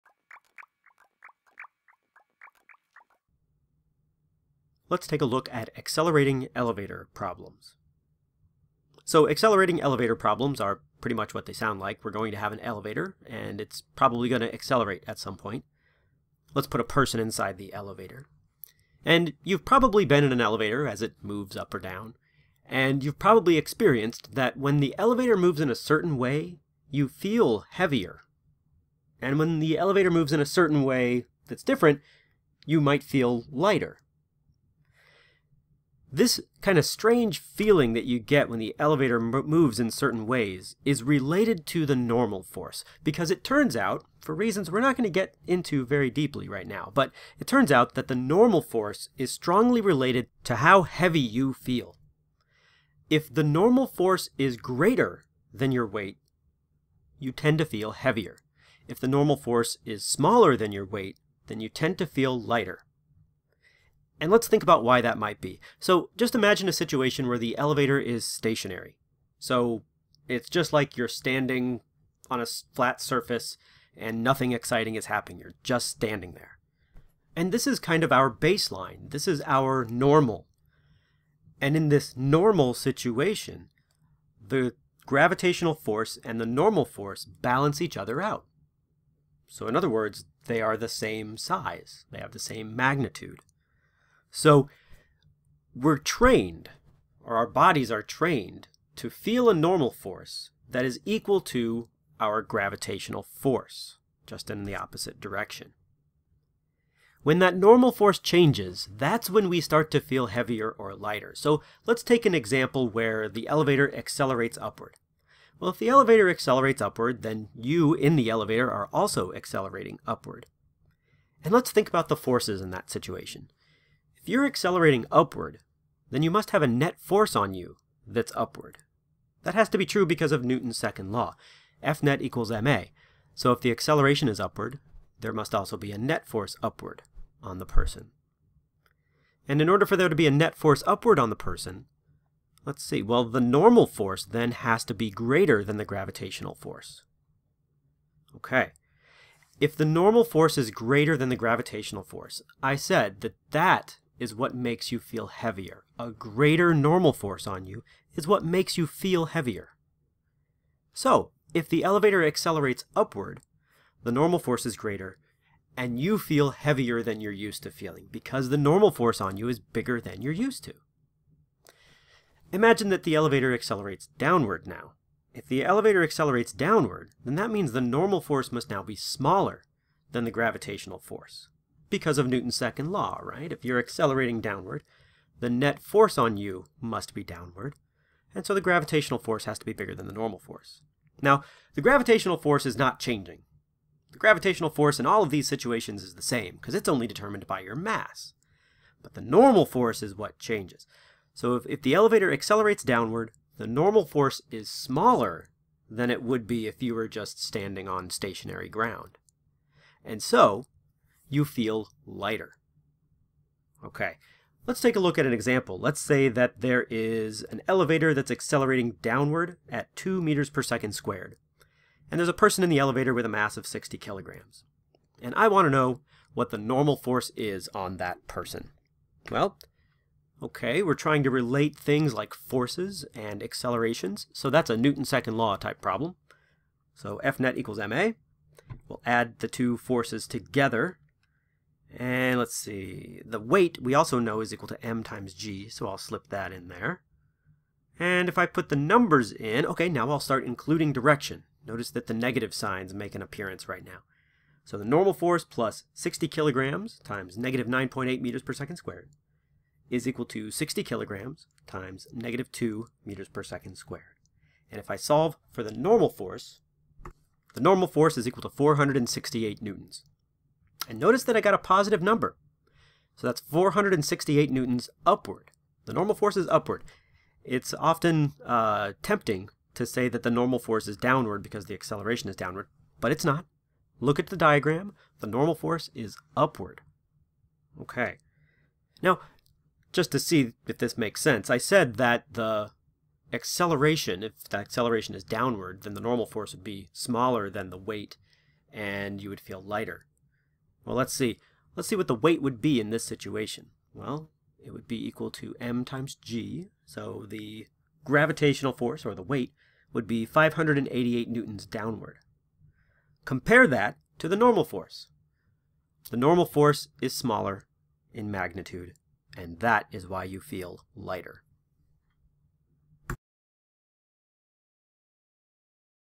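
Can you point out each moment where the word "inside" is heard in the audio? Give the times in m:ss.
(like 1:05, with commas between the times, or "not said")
0:17.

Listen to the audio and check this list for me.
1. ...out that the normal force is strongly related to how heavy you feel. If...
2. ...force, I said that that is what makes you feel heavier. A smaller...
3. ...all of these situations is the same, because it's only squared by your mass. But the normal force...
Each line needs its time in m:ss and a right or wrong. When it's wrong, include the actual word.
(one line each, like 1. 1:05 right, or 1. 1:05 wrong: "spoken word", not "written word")
1. 0:47 right
2. 2:32 wrong: "greater", not "smaller"
3. 3:15 wrong: "determined", not "squared".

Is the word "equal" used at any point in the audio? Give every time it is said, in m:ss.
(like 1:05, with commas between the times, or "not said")
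1:41, 2:12, 3:57, 4:04, 4:20, 4:28, 5:05.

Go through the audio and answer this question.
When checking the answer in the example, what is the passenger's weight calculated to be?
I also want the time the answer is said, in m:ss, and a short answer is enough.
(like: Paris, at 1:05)
588 newtons, at 5:10.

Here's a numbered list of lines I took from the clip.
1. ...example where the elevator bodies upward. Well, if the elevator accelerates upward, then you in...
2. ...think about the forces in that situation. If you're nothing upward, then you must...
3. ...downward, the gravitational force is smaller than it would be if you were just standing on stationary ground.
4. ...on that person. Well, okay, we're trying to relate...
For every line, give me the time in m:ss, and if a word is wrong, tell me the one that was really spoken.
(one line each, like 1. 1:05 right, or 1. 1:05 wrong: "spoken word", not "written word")
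1. 1:52 wrong: "accelerates", not "bodies"
2. 2:01 wrong: "accelerating", not "nothing"
3. 3:22 wrong: "normal", not "gravitational"
4. 3:47 right.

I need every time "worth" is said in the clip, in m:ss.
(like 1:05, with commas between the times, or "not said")
not said.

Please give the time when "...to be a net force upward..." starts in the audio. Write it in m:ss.
2:20.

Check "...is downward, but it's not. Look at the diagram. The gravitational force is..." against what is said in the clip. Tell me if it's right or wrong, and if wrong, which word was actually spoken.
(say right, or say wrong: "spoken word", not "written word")
wrong: "normal", not "gravitational".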